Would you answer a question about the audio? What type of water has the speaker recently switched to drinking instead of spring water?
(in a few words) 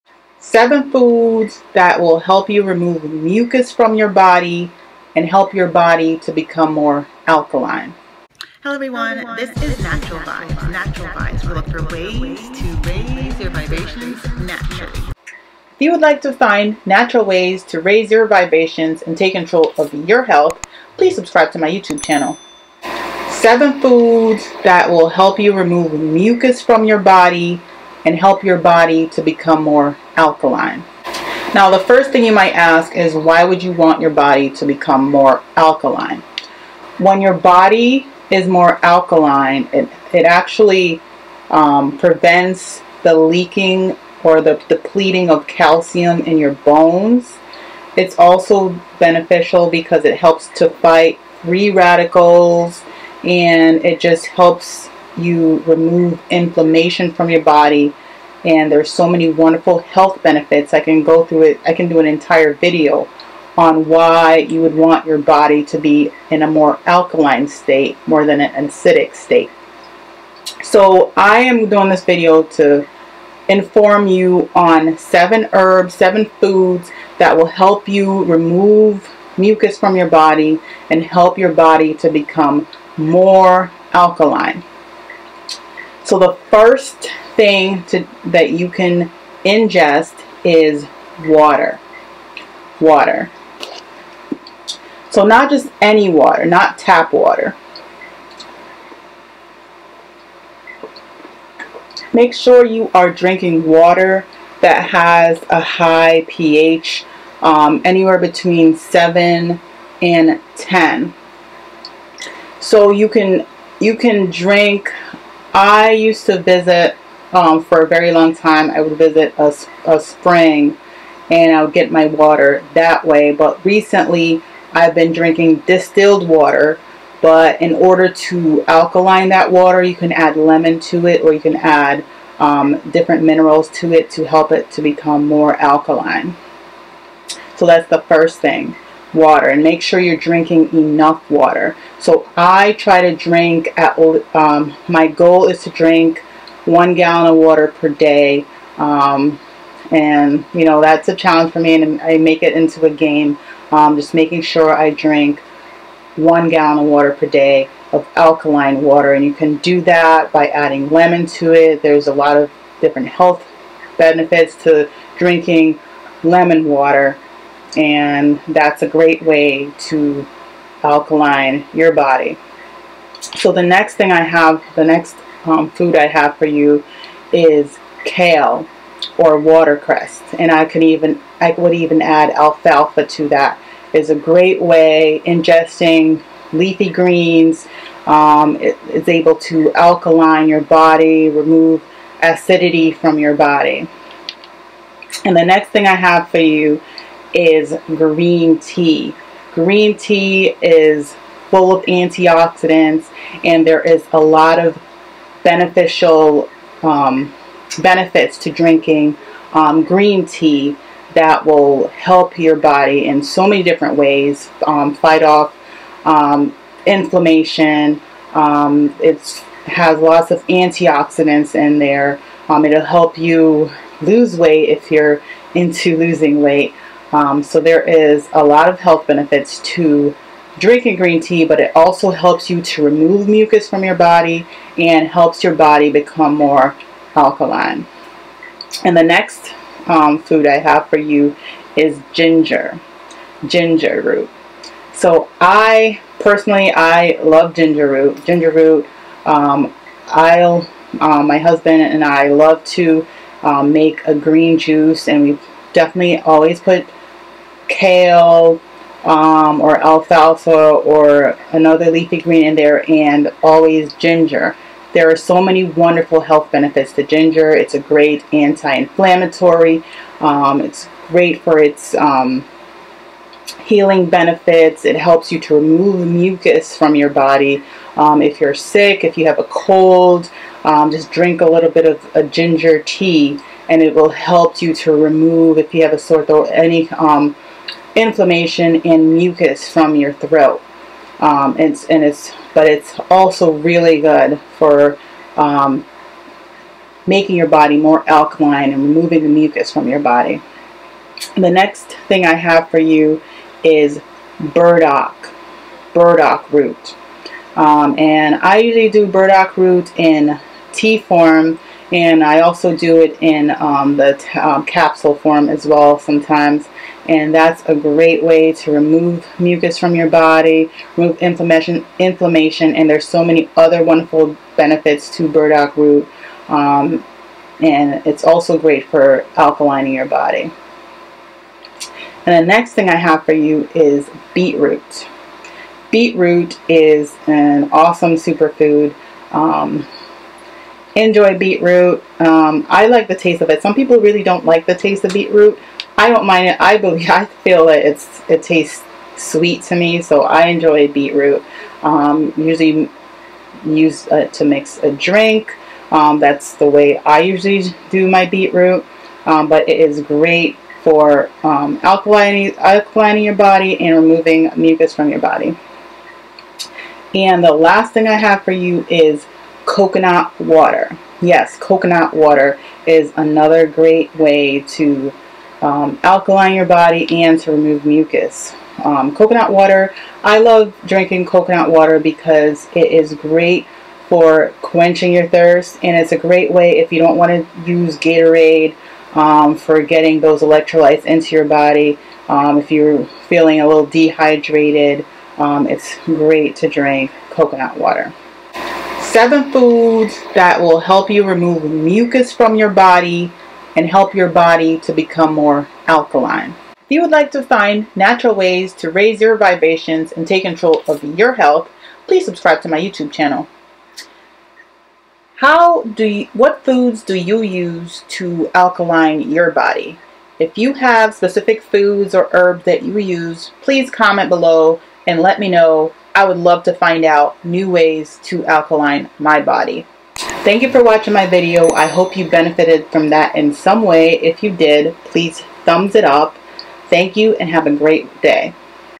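distilled water.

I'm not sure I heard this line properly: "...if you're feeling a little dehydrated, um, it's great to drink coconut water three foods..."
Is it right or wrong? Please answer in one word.
wrong.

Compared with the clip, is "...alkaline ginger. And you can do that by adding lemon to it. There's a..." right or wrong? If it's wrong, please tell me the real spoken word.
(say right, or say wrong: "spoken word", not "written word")
wrong: "water", not "ginger".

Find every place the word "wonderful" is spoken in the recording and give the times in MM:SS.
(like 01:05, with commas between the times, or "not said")
00:59, 04:25, 05:23.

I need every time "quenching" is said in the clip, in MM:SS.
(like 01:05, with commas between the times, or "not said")
06:24.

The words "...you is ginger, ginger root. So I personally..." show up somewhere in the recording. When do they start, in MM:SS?
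04:00.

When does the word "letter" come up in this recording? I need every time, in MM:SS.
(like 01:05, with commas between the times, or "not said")
not said.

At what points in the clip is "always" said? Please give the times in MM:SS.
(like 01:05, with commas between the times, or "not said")
04:16, 04:23.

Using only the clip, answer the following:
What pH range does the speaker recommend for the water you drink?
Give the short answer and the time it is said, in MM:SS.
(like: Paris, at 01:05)
7 to 10, at 01:48.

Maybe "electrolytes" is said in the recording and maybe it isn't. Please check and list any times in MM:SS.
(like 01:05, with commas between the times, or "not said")
06:30.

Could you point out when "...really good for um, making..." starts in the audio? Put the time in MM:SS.
04:53.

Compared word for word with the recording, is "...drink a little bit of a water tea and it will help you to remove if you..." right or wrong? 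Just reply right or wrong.
wrong.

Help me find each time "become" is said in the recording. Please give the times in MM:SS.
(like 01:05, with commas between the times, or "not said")
00:06, 00:29, 00:34, 01:22, 02:14, 03:55, 06:44.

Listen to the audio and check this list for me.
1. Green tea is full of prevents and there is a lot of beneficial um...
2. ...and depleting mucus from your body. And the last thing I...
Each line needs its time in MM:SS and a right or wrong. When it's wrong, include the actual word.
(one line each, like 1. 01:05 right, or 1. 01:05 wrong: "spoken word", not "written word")
1. 03:19 wrong: "antioxidants", not "prevents"
2. 06:03 wrong: "removing", not "depleting".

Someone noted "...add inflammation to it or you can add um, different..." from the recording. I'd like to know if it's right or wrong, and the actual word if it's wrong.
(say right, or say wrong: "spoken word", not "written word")
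wrong: "lemon", not "inflammation".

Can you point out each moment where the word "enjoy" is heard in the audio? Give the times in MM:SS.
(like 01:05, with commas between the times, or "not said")
05:40, 05:50.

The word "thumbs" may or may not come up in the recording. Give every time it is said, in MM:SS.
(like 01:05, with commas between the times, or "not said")
07:15.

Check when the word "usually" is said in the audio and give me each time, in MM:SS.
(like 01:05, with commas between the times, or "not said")
05:08, 05:52, 05:57.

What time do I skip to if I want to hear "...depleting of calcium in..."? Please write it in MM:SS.
00:44.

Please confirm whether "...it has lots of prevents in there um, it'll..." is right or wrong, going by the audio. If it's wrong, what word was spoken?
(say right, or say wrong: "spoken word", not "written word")
wrong: "antioxidants", not "prevents".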